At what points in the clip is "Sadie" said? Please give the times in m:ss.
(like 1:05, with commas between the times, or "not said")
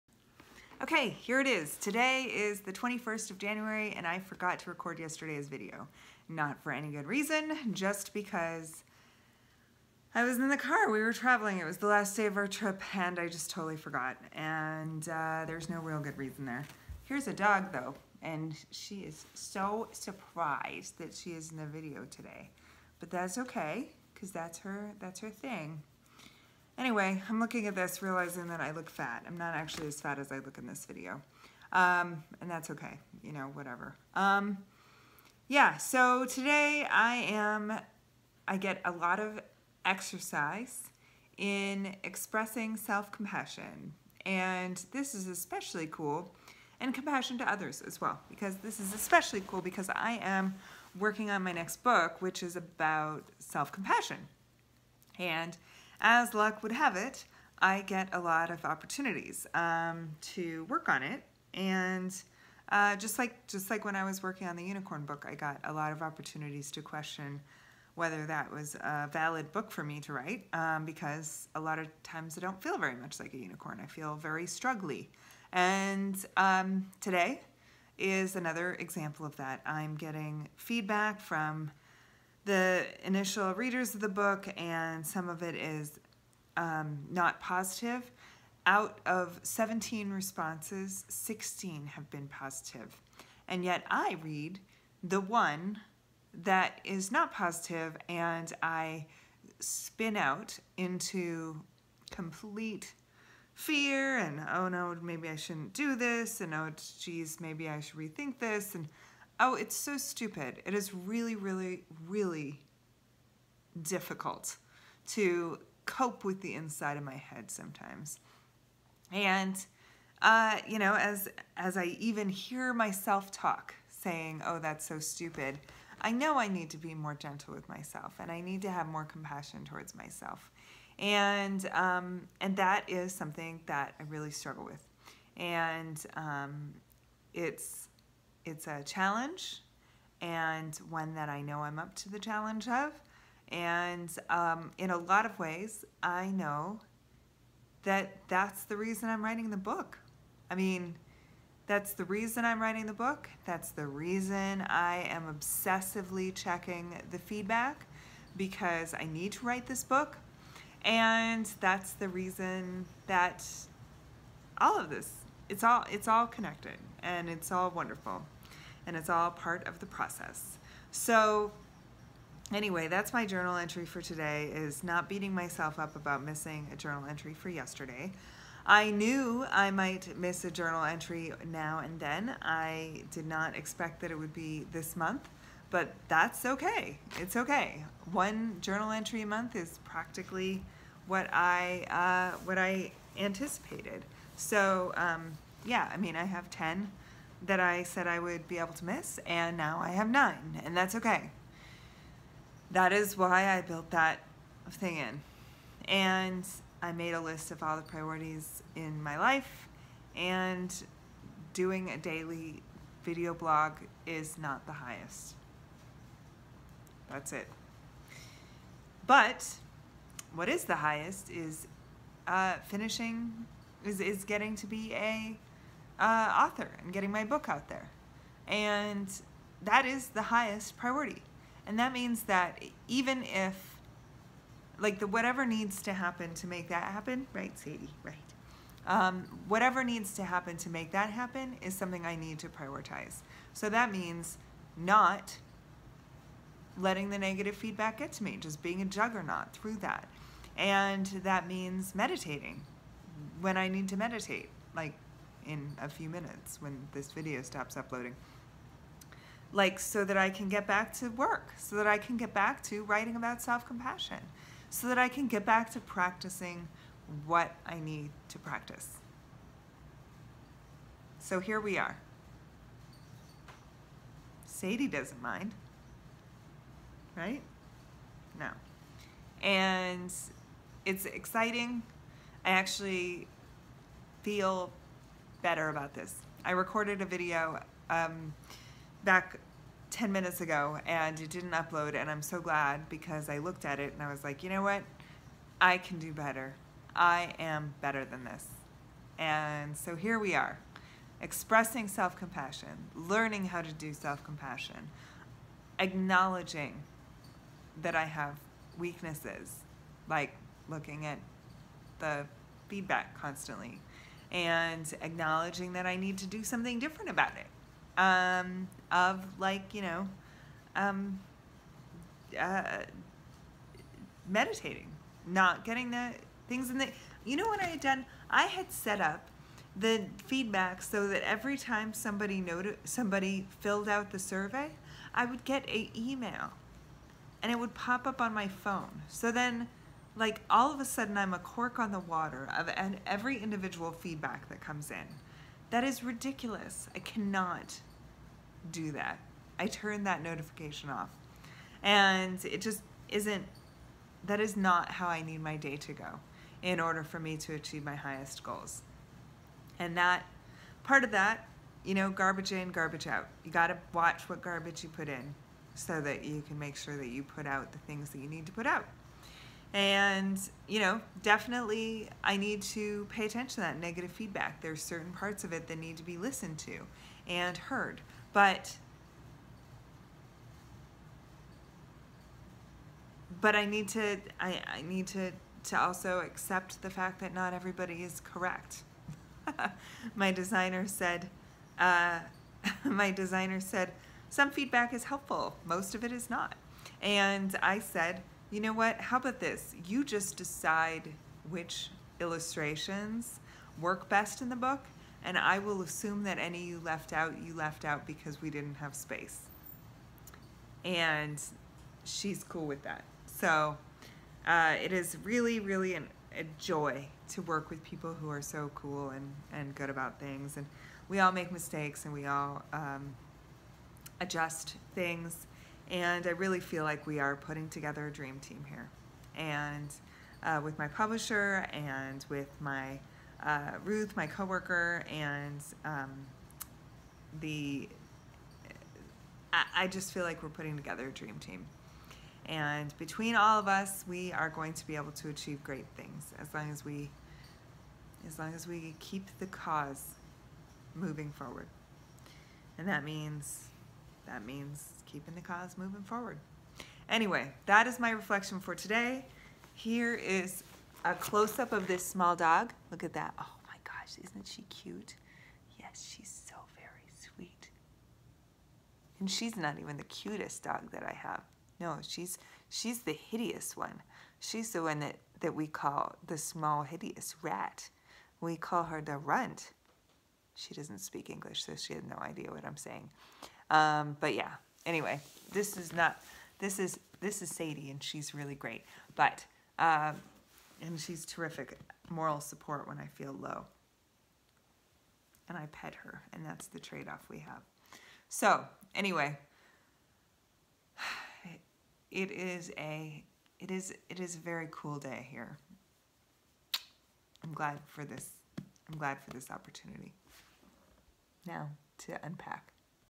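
3:57, 4:34, 8:07.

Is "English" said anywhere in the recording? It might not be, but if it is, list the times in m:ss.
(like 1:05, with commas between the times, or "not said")
8:01.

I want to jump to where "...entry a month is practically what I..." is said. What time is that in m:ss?
3:08.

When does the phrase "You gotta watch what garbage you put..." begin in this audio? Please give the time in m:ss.
6:03.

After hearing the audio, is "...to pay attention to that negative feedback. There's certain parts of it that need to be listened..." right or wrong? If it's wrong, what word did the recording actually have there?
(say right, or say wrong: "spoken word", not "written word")
right.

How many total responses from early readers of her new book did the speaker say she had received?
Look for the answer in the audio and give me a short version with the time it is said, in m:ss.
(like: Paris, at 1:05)
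17, at 1:29.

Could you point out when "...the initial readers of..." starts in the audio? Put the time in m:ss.
1:22.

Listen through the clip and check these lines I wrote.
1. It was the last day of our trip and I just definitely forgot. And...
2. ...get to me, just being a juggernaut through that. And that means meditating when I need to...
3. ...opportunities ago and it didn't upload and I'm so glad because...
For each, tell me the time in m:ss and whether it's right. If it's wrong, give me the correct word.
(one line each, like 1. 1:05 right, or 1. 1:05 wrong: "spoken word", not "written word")
1. 0:11 wrong: "totally", not "definitely"
2. 4:07 right
3. 4:50 wrong: "minutes", not "opportunities".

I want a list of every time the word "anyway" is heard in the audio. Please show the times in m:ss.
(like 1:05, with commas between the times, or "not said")
0:26, 2:52, 7:37, 8:04, 8:18.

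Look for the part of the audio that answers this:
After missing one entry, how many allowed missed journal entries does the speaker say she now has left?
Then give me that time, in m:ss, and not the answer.
3:20.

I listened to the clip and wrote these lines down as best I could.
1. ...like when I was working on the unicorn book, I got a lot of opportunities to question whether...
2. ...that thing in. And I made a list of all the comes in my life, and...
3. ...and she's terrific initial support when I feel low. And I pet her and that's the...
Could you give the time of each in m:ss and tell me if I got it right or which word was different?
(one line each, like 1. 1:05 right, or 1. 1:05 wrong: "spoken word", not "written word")
1. 1:03 right
2. 3:23 wrong: "priorities", not "comes"
3. 8:10 wrong: "moral", not "initial".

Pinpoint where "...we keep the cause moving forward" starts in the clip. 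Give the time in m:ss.
7:28.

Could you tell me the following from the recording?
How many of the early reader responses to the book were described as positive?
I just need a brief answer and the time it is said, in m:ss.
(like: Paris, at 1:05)
16, at 1:31.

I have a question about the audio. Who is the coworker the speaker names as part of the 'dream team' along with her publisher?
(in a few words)
Ruth.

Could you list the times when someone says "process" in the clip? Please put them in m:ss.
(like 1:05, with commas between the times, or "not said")
2:49.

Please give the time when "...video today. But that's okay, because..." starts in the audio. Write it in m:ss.
0:21.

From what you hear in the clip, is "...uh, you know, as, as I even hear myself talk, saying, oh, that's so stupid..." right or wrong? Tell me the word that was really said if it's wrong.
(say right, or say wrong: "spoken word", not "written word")
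right.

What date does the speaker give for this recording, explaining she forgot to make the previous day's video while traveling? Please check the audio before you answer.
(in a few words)
January 21.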